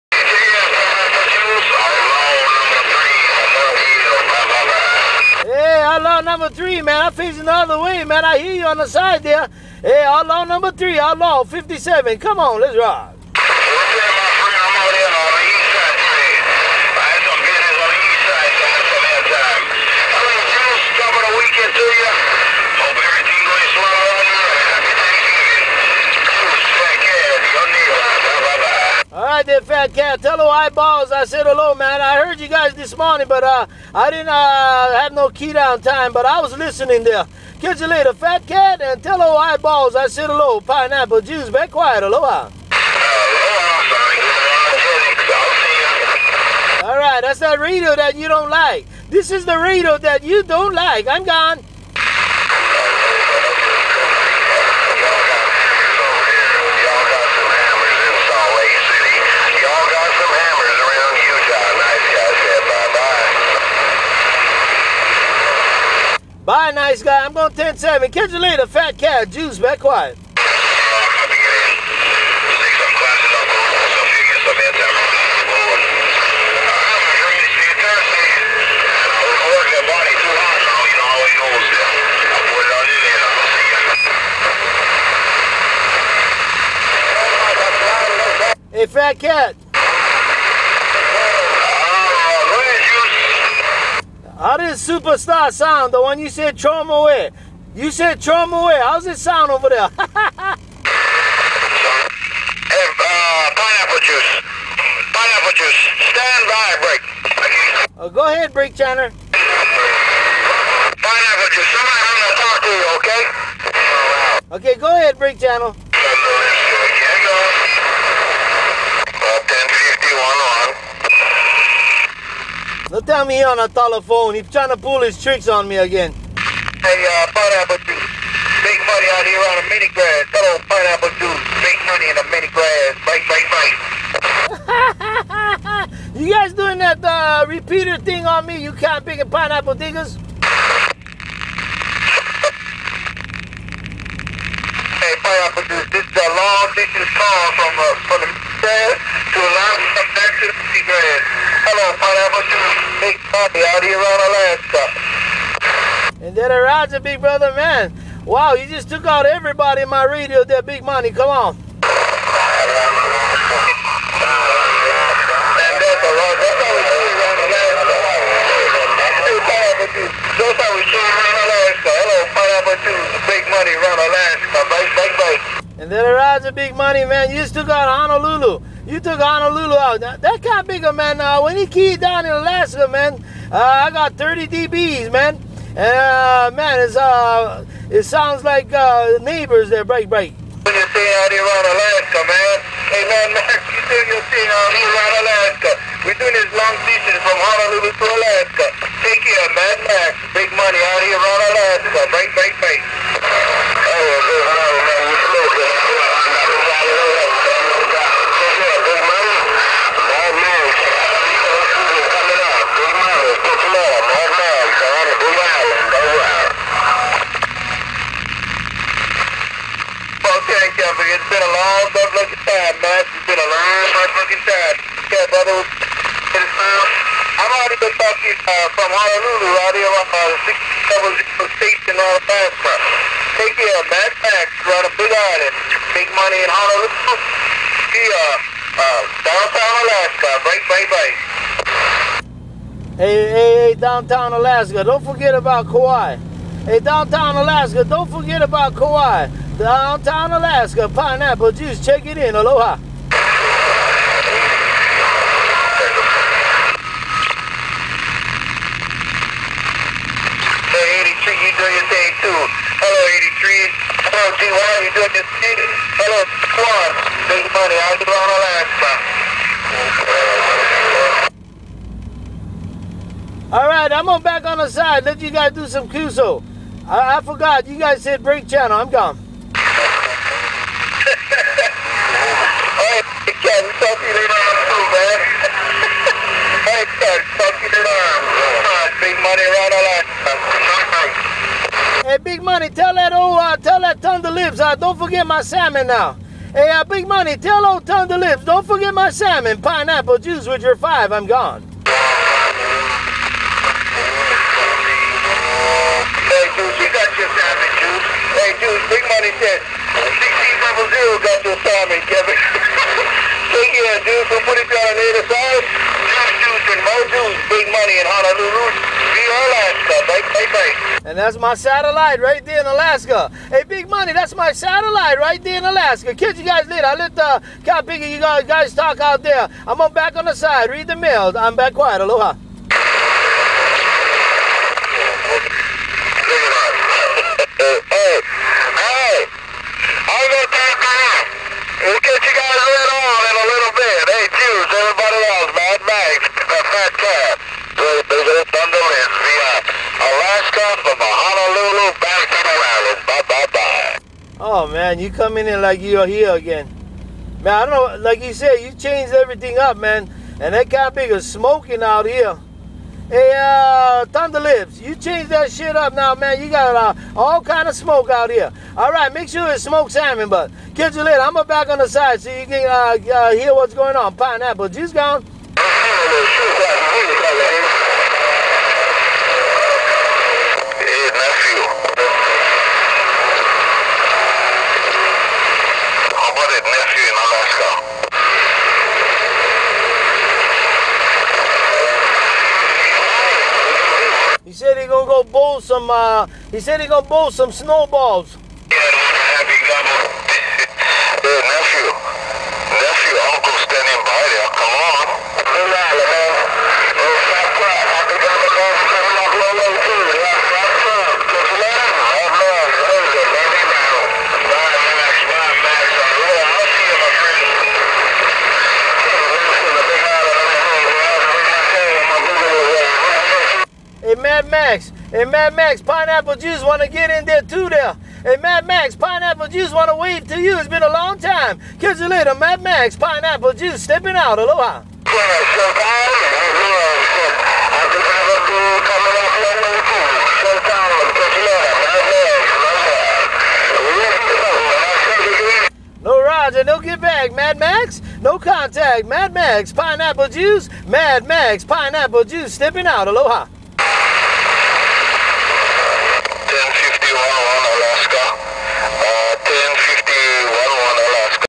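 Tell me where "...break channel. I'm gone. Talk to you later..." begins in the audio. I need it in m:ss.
4:38.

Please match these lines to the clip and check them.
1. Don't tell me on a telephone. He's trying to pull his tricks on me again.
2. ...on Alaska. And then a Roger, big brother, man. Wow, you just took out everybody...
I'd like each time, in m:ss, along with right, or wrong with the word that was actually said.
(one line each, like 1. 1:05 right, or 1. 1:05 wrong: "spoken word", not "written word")
1. 2:02 right
2. 2:33 right.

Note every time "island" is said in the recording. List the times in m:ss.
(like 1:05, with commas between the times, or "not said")
3:55.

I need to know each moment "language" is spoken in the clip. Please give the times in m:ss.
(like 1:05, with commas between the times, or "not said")
not said.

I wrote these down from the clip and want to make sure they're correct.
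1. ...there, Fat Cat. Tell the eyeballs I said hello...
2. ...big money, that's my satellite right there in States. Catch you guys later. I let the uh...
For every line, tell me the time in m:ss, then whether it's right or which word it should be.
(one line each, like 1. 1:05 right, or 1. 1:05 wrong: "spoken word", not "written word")
1. 0:29 right
2. 5:23 wrong: "Alaska", not "States".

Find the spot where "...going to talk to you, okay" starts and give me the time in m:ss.
1:52.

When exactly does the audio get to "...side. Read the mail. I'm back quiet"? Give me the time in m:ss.
5:30.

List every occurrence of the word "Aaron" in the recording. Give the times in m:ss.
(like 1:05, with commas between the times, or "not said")
not said.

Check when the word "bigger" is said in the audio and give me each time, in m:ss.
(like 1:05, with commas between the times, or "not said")
3:00.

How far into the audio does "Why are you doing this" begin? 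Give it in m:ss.
4:24.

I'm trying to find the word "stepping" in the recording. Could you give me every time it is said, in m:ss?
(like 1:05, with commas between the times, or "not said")
7:13, 7:32.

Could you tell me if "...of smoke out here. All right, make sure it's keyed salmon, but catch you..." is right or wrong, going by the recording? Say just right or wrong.
wrong.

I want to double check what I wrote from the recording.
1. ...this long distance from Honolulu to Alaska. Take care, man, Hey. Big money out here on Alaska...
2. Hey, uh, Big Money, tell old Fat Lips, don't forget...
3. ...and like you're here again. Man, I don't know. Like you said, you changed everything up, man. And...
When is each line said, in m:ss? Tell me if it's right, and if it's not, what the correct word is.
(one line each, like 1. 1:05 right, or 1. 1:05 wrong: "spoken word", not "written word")
1. 3:16 wrong: "Max", not "Hey"
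2. 4:56 wrong: "Thunder", not "Fat"
3. 5:55 right.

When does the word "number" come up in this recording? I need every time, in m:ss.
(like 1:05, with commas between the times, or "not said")
0:06, 0:10.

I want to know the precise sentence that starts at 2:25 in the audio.
This is a long distance call from, uh, from the grass to a long distance to the grass.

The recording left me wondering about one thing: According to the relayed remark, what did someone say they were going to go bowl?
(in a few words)
snowballs.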